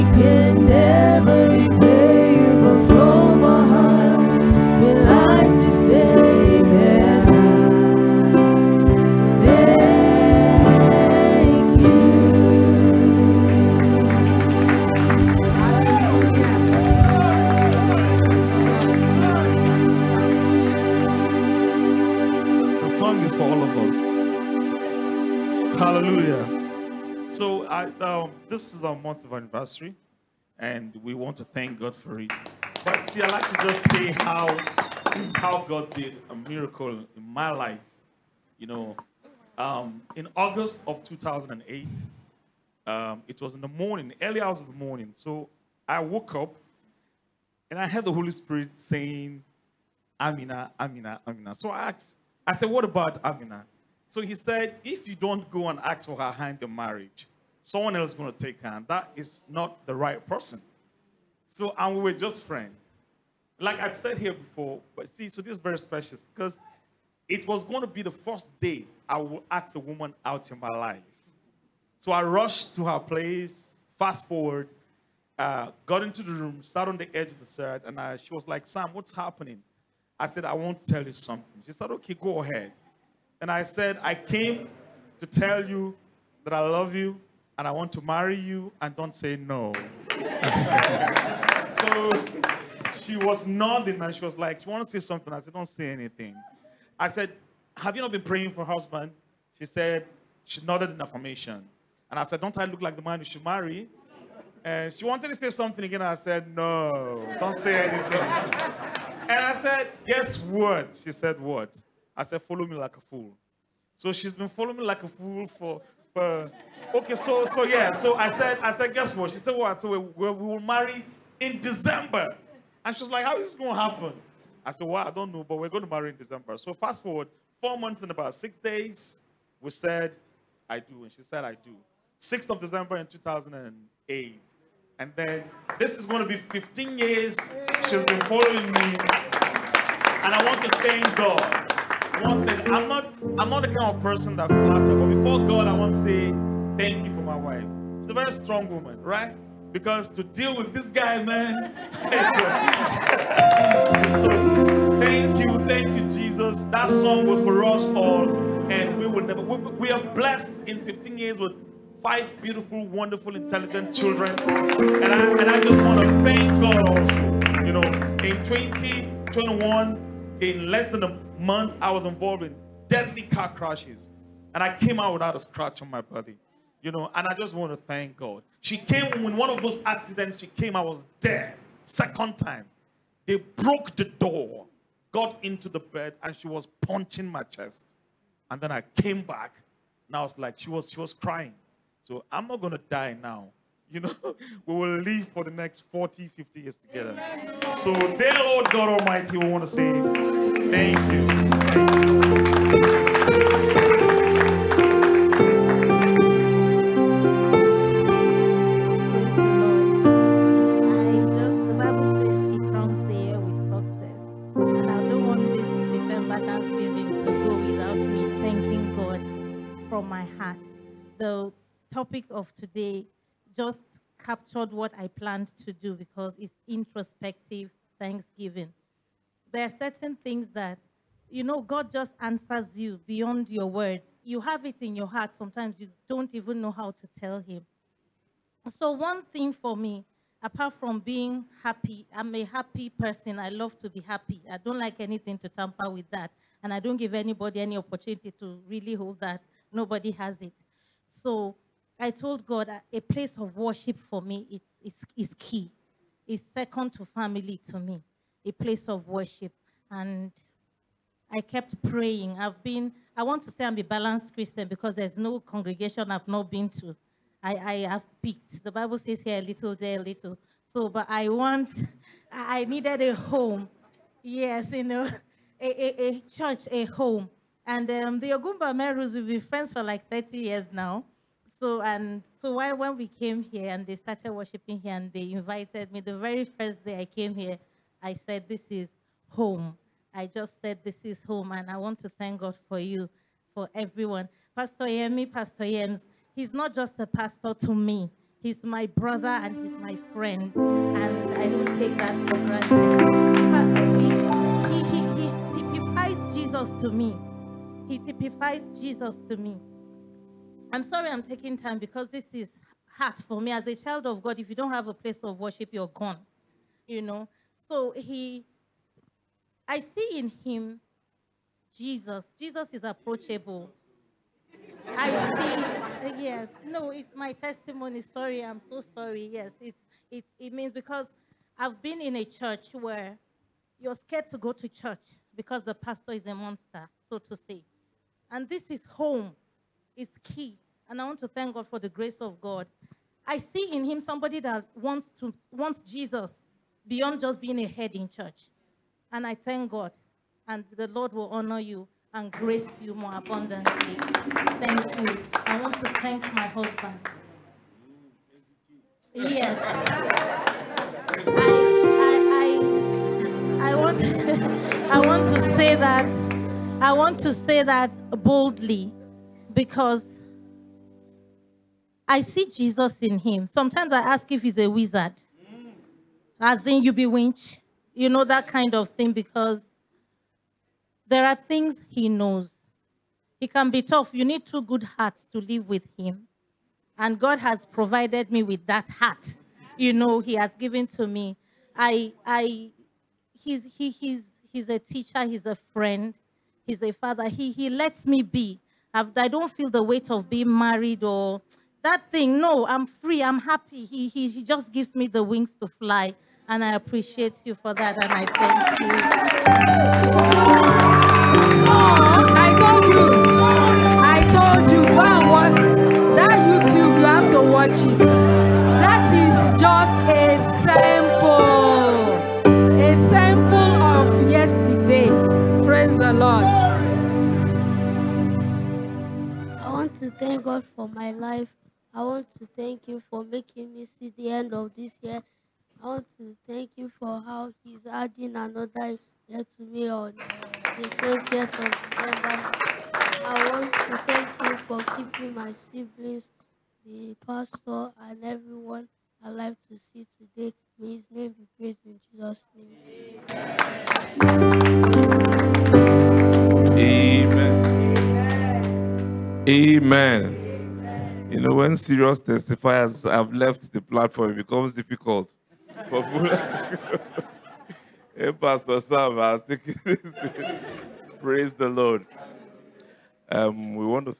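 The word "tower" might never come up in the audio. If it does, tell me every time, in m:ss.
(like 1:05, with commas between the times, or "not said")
not said.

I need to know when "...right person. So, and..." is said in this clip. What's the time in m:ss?
0:59.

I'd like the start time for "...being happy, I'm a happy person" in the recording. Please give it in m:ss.
4:00.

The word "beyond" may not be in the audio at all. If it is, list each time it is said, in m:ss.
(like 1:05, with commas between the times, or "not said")
3:53, 5:46.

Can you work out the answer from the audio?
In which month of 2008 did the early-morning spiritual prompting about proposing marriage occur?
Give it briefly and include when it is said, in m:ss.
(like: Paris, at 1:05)
August, at 0:40.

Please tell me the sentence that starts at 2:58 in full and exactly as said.
She came in one of those accidents, she came, I was there.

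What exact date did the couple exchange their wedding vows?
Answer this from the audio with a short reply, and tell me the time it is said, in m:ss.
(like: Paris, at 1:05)
6 December 2008, at 2:12.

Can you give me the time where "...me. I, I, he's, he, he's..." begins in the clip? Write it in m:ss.
6:31.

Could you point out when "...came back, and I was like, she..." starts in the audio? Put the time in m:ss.
3:08.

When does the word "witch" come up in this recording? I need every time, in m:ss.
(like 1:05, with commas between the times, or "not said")
6:17.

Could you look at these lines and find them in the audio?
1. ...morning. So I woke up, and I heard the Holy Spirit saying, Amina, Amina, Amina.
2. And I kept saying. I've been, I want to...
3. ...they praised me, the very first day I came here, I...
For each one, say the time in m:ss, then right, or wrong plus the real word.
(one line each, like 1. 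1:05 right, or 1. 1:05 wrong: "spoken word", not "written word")
1. 0:44 right
2. 4:19 wrong: "praying", not "saying"
3. 4:45 wrong: "invited", not "praised".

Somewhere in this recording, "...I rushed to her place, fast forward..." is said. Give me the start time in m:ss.
1:12.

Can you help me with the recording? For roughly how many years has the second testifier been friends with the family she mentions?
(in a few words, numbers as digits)
30.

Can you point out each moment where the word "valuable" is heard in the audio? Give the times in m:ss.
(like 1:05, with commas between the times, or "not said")
not said.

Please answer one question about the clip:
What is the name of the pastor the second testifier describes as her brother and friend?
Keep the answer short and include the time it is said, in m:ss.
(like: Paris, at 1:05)
Pastor Yemi, at 4:54.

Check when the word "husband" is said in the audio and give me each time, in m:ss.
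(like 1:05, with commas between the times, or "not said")
1:38, 5:56.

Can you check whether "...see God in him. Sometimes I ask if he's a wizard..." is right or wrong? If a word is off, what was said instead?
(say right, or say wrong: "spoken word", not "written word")
wrong: "Jesus", not "God".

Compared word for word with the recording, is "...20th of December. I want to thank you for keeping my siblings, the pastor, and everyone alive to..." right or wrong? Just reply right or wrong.
right.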